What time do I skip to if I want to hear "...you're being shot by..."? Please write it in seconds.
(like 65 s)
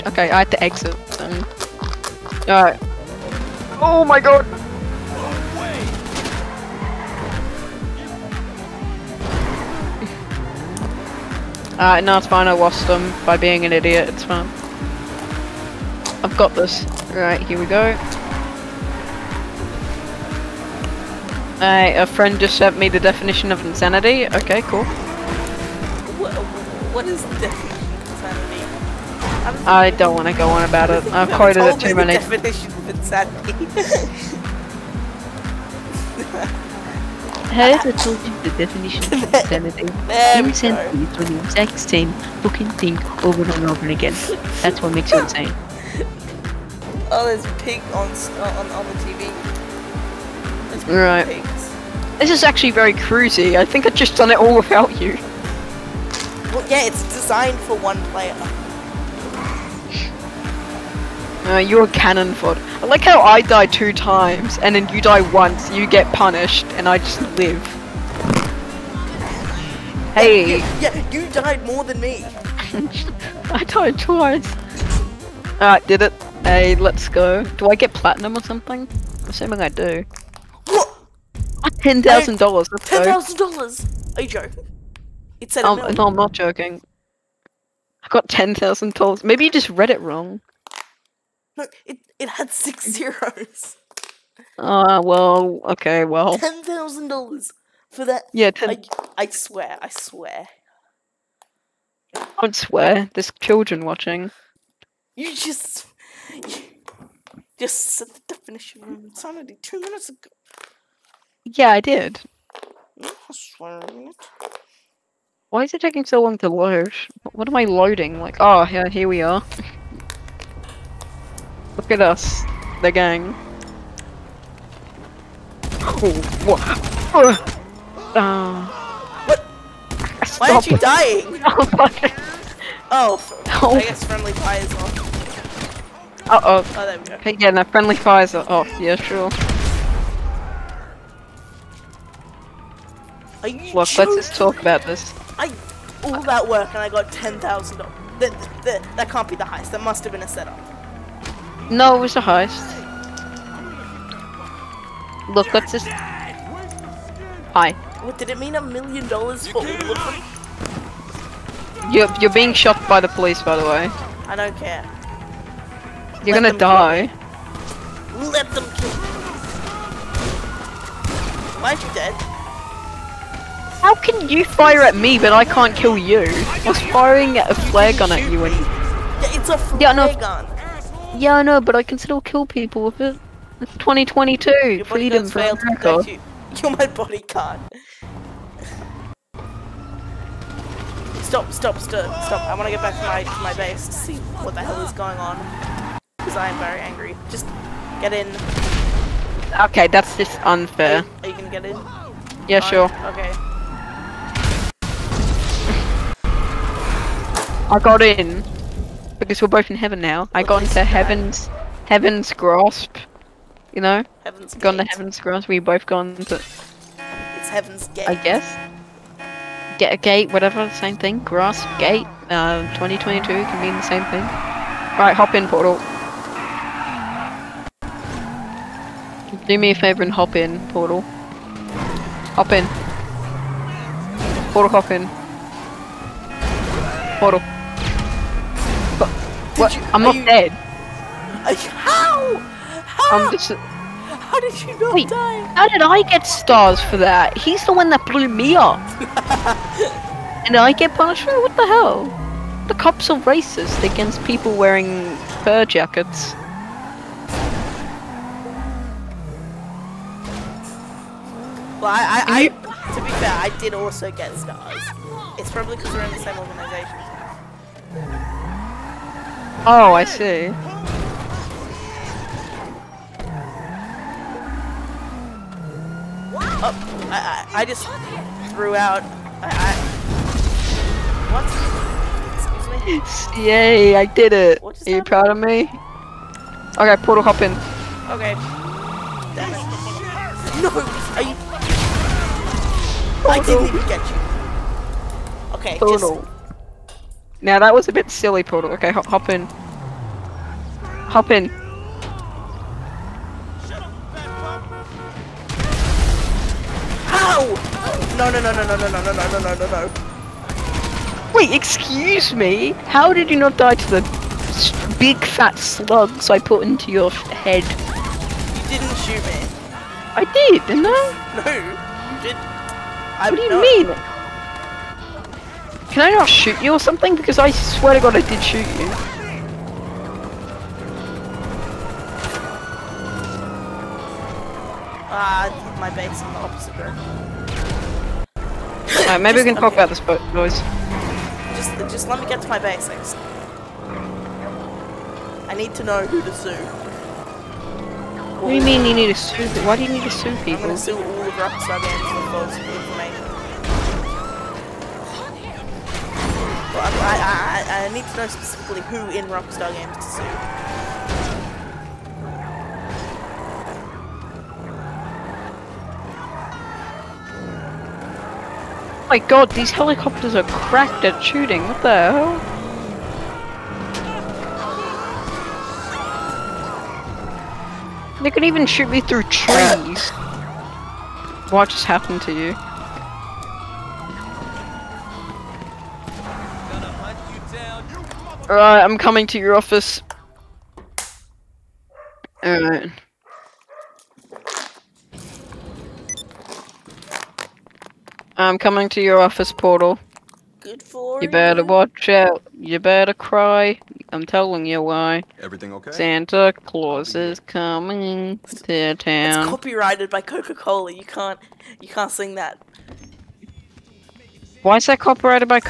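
162 s.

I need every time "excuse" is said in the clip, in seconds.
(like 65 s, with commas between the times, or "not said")
282 s, 311 s.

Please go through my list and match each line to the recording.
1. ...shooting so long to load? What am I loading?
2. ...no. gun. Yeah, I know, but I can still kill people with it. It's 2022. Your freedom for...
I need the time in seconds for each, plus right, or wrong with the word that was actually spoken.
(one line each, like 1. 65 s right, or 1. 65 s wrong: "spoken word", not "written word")
1. 115 s wrong: "taking", not "shooting"
2. 179 s right.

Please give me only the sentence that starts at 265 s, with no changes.
It's probably because we're in the same organization.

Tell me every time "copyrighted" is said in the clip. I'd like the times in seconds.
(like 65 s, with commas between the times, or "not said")
409 s, 414 s.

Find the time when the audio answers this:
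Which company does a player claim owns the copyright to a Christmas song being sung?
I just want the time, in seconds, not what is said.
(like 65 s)
410 s.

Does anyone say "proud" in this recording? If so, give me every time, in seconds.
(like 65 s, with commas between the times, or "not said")
285 s.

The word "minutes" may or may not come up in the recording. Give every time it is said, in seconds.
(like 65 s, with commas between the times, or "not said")
109 s.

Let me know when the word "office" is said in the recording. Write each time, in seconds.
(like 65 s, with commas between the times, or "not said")
389 s, 399 s.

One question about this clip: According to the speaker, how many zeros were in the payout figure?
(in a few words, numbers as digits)
6.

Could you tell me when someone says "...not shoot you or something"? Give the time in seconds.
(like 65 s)
326 s.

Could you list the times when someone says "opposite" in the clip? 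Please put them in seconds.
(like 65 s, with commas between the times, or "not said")
336 s.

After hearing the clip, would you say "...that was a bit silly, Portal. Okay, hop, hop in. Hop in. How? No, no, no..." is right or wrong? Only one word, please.
right.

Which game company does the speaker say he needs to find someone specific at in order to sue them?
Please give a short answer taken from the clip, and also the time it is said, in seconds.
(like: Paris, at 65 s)
Rockstar Games, at 359 s.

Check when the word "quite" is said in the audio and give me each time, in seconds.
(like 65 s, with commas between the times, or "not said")
not said.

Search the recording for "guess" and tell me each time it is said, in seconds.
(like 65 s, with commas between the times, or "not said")
133 s, 218 s.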